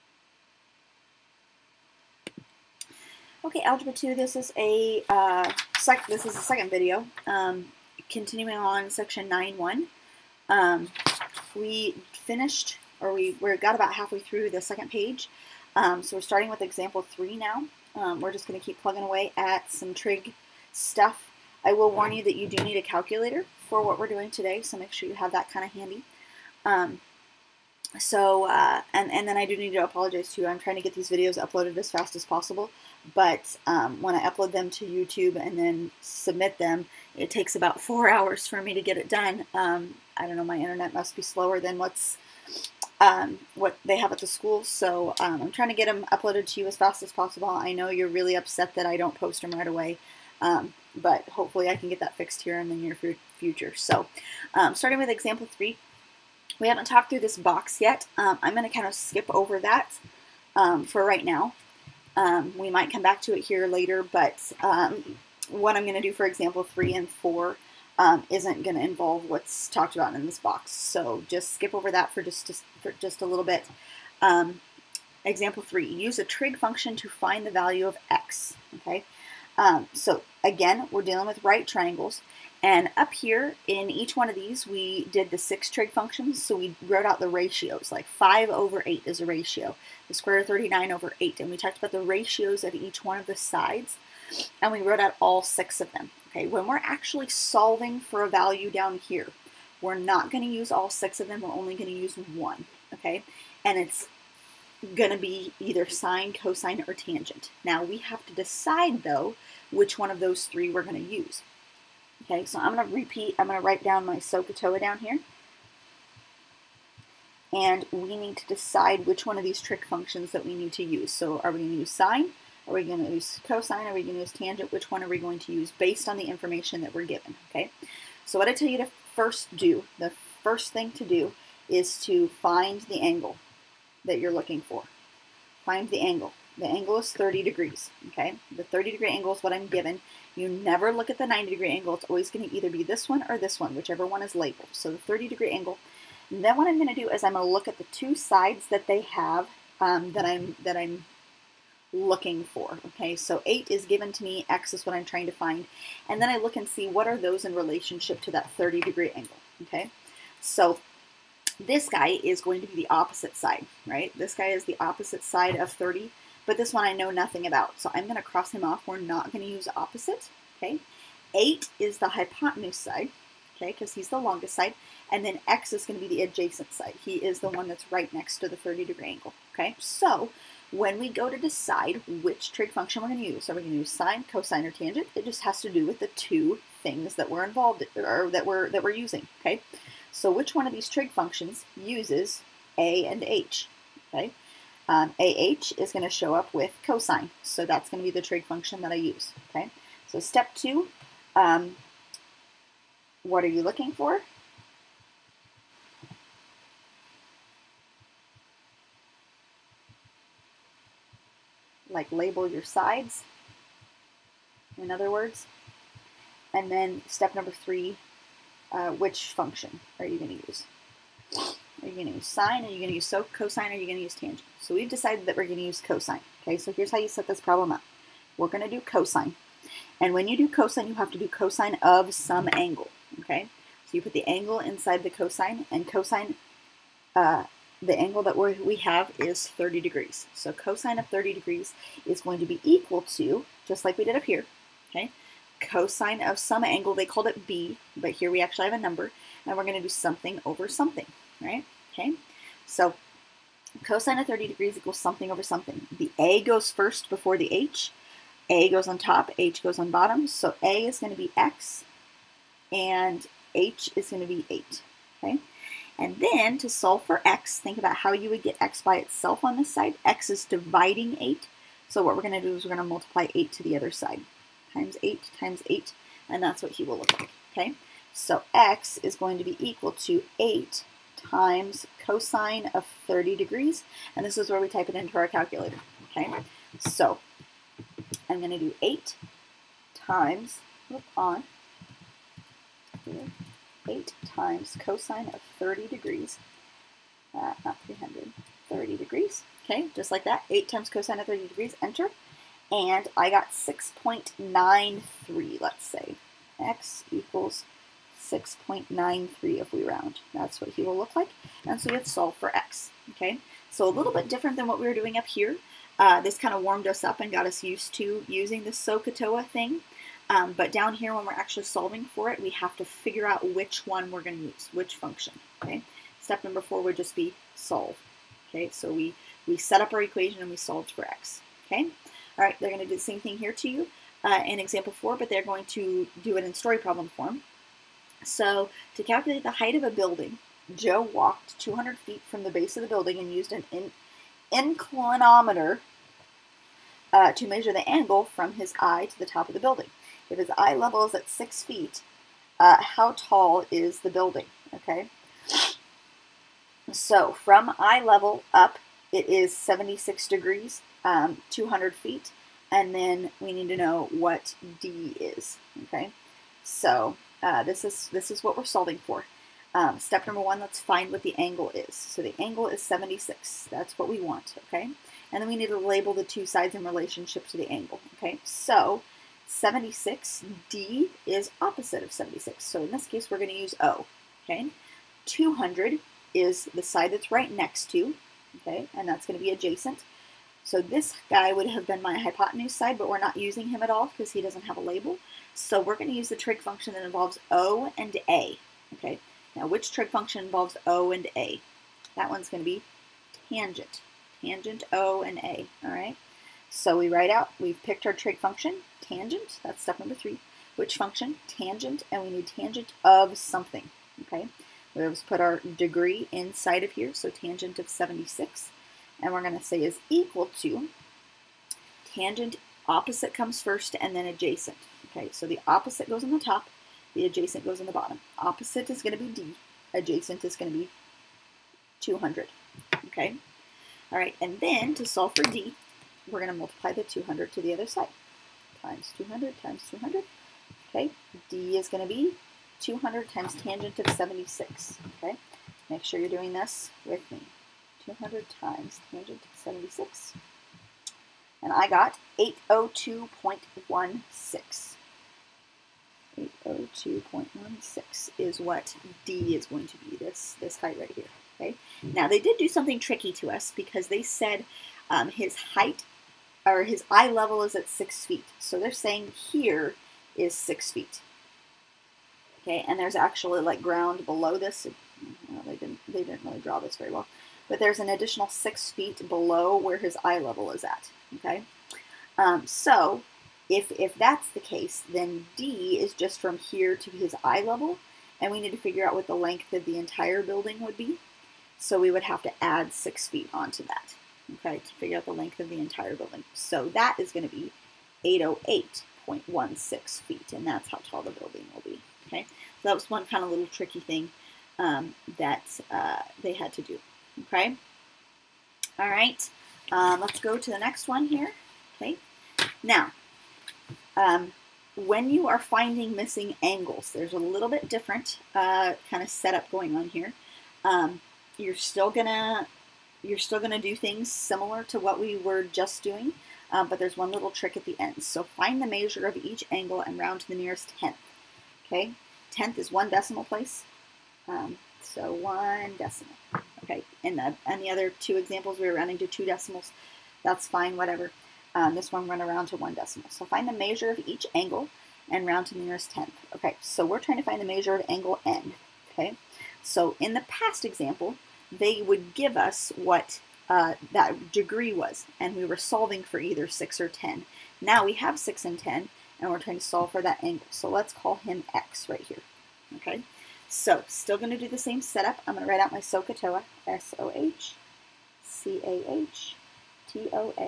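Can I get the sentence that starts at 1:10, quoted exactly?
So just skip over that for just, just, for just a little bit.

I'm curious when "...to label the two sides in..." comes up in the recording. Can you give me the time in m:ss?
6:15.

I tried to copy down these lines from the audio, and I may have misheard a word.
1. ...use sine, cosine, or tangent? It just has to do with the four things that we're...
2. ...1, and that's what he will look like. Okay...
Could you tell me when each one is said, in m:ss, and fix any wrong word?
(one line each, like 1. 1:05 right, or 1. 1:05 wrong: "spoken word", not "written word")
1. 3:03 wrong: "two", not "four"
2. 4:35 wrong: "8", not "1".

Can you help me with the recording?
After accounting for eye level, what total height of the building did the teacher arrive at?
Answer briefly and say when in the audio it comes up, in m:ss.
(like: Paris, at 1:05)
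808.16 feet, at 8:18.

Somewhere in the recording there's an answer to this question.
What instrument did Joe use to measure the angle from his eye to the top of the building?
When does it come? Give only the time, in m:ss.
5:44.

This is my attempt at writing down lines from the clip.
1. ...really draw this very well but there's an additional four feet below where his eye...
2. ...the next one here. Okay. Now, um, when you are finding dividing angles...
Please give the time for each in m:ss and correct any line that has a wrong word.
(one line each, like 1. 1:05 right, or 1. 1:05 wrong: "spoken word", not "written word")
1. 7:56 wrong: "six", not "four"
2. 8:30 wrong: "missing", not "dividing".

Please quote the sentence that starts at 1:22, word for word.
And up here in each one of these, we did the six trig functions.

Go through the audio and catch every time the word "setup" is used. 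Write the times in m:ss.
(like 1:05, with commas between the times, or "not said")
8:39, 9:25.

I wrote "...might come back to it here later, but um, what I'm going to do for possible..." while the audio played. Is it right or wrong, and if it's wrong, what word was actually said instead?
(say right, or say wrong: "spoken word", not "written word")
wrong: "example", not "possible".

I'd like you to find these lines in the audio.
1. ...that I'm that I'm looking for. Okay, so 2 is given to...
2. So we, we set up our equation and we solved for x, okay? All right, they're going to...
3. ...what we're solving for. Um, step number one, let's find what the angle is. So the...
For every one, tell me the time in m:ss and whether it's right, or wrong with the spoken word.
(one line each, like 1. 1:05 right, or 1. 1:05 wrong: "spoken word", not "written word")
1. 2:30 wrong: "8", not "2"
2. 5:28 right
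3. 6:08 right.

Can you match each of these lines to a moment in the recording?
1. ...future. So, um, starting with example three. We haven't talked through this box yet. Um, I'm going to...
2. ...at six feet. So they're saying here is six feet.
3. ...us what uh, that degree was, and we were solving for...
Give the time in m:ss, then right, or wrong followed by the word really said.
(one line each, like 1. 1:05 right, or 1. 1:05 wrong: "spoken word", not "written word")
1. 0:53 right
2. 7:47 right
3. 9:12 right.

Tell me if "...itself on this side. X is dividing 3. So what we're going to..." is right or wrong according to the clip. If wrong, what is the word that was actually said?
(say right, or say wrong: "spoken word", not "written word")
wrong: "8", not "3".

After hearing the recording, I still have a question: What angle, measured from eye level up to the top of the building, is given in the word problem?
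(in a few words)
76 degrees.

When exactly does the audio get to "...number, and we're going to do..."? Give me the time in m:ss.
4:08.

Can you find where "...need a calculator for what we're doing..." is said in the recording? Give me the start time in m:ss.
0:22.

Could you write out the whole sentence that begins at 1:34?
And we wrote out all six of them.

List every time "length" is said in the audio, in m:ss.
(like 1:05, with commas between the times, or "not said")
8:09, 8:15.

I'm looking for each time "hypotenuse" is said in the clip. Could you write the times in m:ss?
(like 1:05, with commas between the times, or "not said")
2:52, 6:32.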